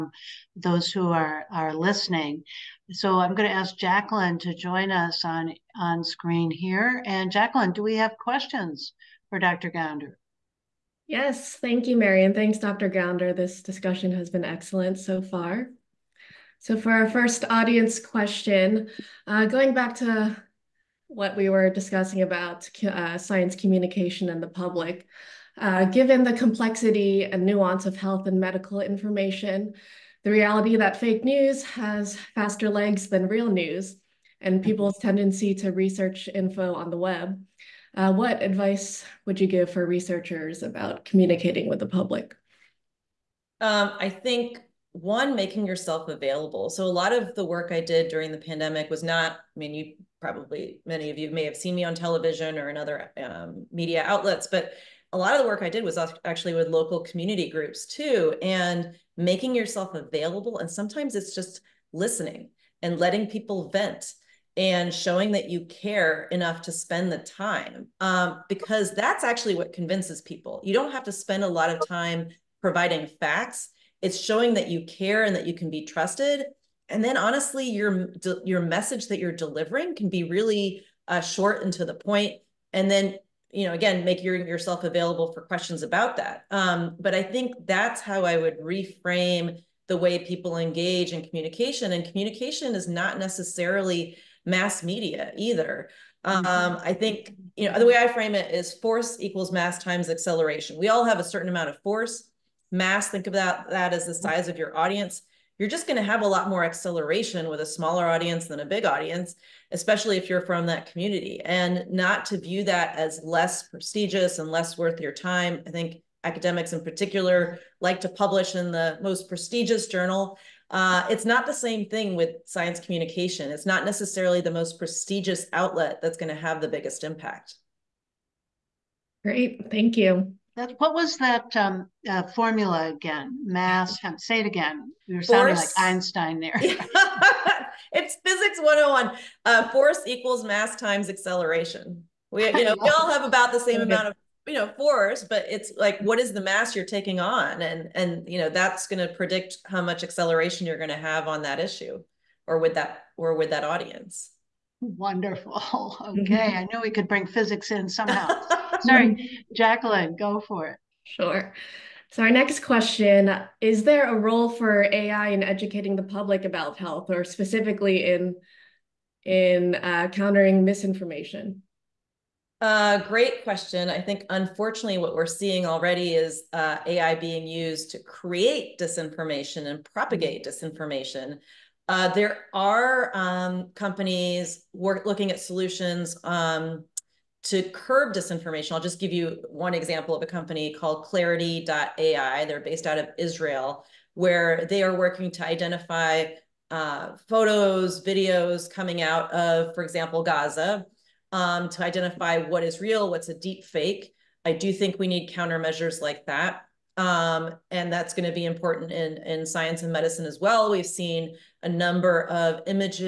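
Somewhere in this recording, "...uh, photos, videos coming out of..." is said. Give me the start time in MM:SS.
03:16.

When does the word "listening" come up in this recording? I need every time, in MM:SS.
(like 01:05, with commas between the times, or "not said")
00:01, 01:01.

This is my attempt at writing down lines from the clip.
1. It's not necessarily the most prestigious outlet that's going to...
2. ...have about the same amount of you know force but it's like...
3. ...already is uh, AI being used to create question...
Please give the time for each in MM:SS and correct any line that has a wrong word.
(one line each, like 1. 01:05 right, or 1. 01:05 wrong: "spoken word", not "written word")
1. 02:03 right
2. 02:23 right
3. 02:55 wrong: "disinformation", not "question".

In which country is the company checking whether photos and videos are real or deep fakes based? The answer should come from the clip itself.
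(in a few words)
Israel.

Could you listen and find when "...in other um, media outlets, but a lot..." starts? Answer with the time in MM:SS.
00:52.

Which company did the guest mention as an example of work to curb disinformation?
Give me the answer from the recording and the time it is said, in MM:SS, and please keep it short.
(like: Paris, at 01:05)
Clarity.ai, at 03:11.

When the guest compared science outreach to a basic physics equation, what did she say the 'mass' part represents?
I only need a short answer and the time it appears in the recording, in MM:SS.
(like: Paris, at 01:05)
Size of your audience, at 01:44.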